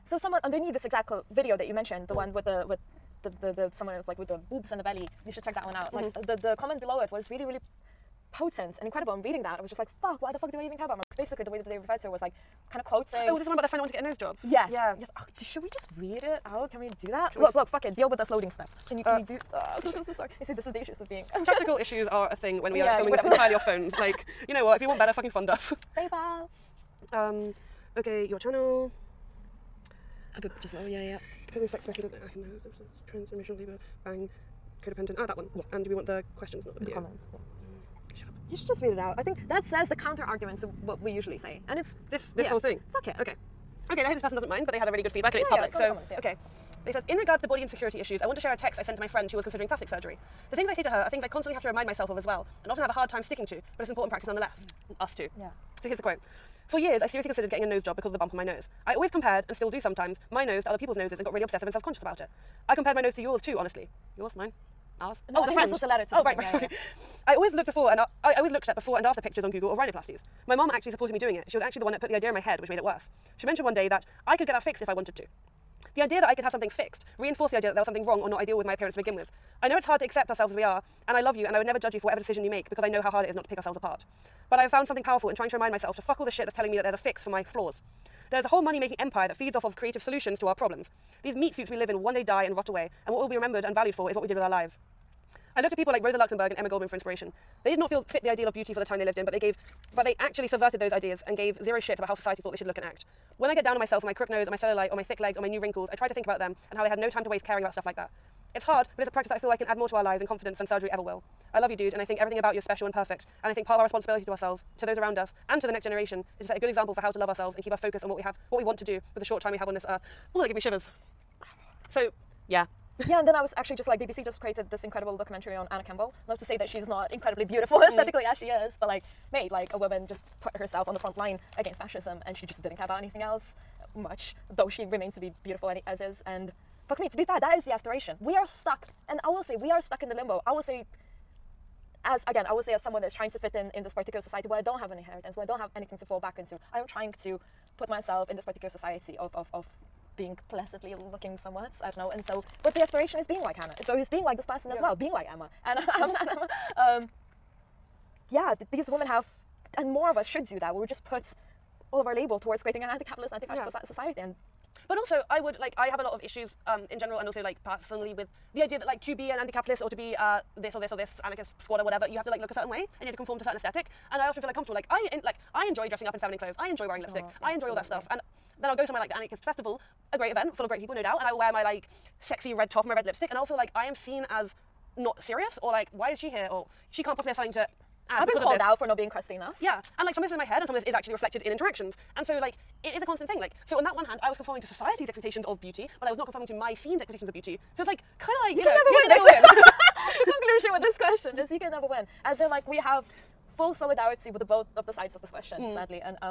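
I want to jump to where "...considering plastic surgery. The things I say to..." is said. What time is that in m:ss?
0:49.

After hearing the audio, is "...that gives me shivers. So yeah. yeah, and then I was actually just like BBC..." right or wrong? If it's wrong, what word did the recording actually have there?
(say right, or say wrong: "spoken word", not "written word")
right.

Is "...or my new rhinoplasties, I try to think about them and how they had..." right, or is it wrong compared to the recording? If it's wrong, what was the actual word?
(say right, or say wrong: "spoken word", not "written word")
wrong: "wrinkles", not "rhinoplasties".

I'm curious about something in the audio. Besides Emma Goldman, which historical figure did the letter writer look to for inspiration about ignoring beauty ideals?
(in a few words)
Rosa Luxemburg.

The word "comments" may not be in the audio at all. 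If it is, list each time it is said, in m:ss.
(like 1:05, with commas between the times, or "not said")
0:06, 0:36, 0:45.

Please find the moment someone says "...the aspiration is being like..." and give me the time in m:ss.
2:32.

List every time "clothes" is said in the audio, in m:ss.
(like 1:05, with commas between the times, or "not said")
2:56.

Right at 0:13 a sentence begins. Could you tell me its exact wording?
Oh, there's the one about their friend that wanted to get a nose job.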